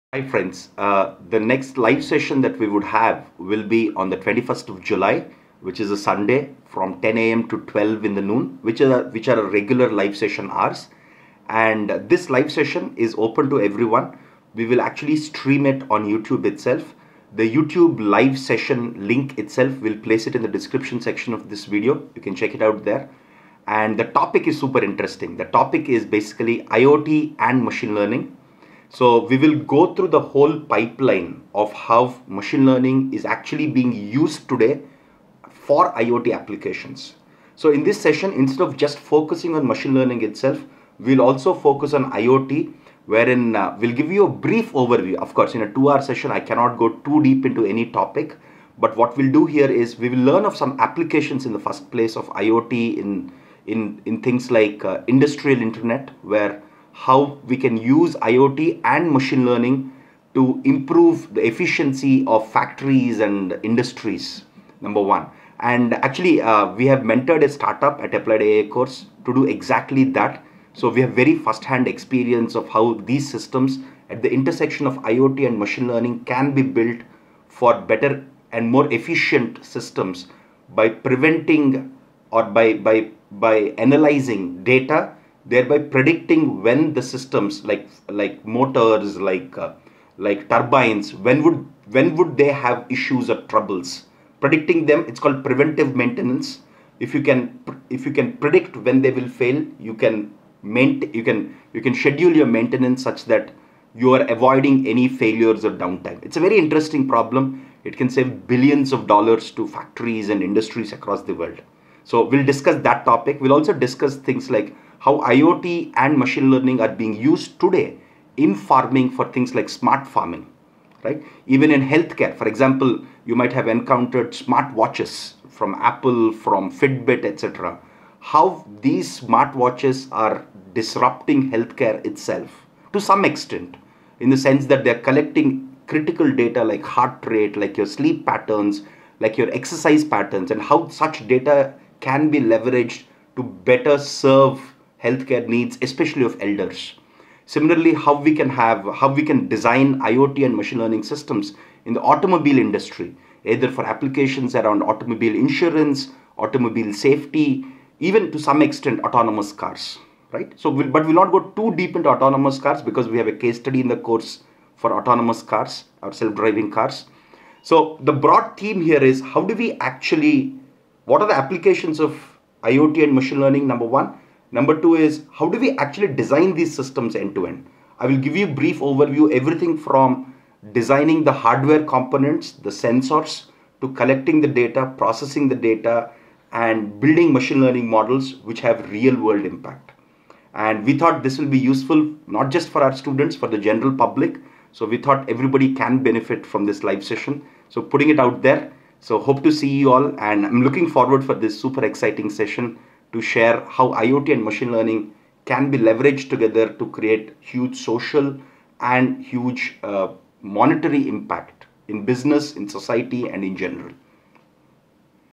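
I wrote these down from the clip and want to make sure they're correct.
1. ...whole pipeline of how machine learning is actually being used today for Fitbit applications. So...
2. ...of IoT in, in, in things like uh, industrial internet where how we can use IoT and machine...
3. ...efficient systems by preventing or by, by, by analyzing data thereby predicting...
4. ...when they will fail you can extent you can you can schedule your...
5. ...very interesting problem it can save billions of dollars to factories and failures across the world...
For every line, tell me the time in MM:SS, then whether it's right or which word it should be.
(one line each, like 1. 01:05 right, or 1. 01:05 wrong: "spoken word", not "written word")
1. 00:30 wrong: "IoT", not "Fitbit"
2. 00:52 right
3. 01:18 right
4. 01:38 wrong: "maint", not "extent"
5. 01:46 wrong: "industries", not "failures".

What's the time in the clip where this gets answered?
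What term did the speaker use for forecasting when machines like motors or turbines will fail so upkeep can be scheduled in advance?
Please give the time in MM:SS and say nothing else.
01:35.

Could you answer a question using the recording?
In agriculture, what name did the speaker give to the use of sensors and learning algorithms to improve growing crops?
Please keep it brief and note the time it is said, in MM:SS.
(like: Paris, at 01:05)
Smart farming, at 01:59.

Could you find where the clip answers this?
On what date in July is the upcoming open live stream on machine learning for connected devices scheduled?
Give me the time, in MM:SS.
00:04.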